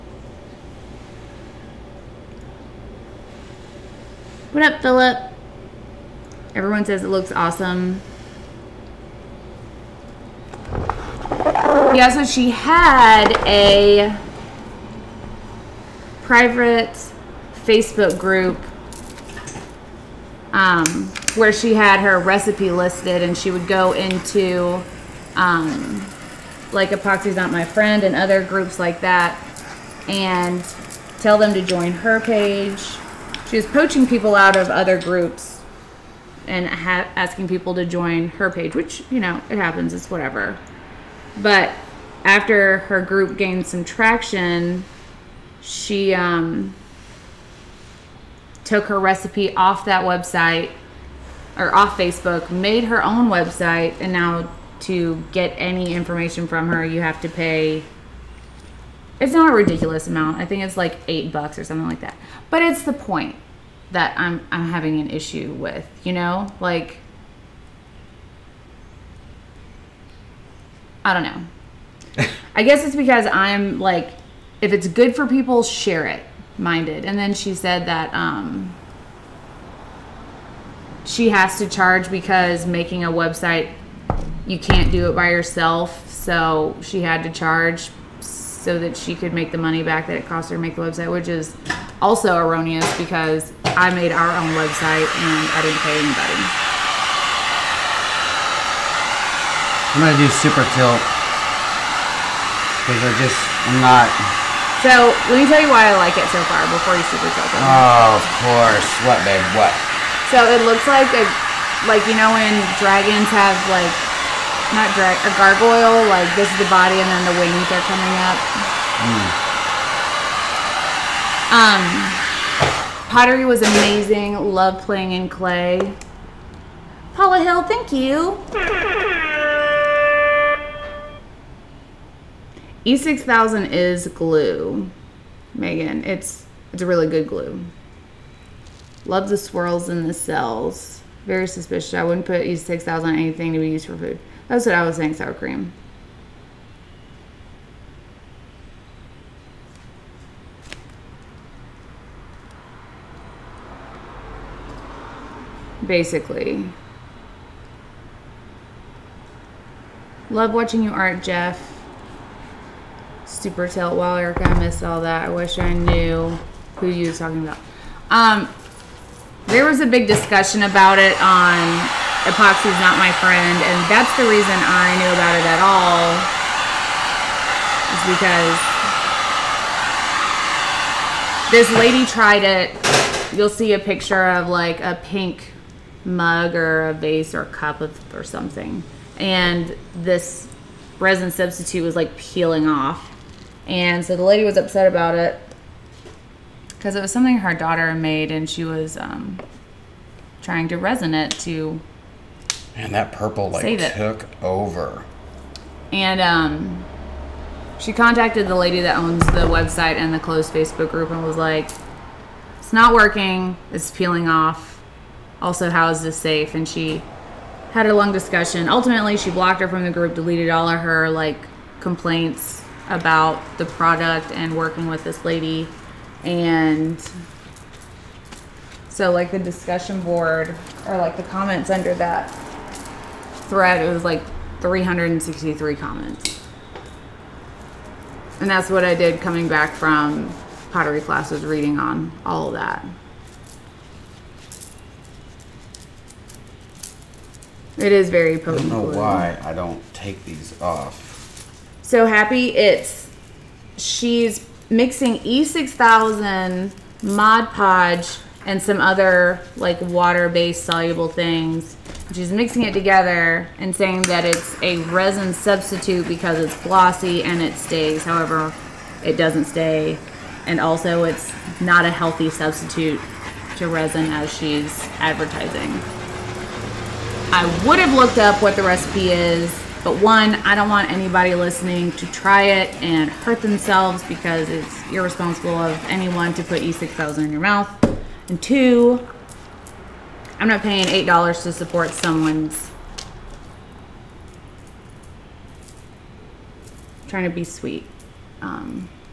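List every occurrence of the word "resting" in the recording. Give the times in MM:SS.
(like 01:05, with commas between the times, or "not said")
not said.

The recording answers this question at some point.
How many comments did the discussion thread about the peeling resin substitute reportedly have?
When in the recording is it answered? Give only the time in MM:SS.
03:54.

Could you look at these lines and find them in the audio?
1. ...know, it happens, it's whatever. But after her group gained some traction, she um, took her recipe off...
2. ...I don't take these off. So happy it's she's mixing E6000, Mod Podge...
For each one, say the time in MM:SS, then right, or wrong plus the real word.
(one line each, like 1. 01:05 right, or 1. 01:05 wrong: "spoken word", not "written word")
1. 00:39 right
2. 04:09 right.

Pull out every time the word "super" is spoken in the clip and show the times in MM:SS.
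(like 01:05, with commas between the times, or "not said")
01:40, 01:47, 02:43.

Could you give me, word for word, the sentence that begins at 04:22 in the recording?
She's mixing it together and saying that it's a resin substitute because it's glossy and it stays.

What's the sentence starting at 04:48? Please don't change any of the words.
And two, I'm not paying $8 to support someone's.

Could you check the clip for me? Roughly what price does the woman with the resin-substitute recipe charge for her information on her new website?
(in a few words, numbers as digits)
$8.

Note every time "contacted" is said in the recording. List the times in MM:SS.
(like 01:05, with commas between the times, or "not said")
03:27.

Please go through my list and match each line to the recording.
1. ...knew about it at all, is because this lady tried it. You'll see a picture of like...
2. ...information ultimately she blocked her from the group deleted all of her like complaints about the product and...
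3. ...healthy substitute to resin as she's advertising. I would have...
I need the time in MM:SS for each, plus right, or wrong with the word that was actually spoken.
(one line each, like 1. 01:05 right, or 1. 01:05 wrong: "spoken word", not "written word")
1. 02:55 right
2. 03:38 wrong: "discussion", not "information"
3. 04:31 right.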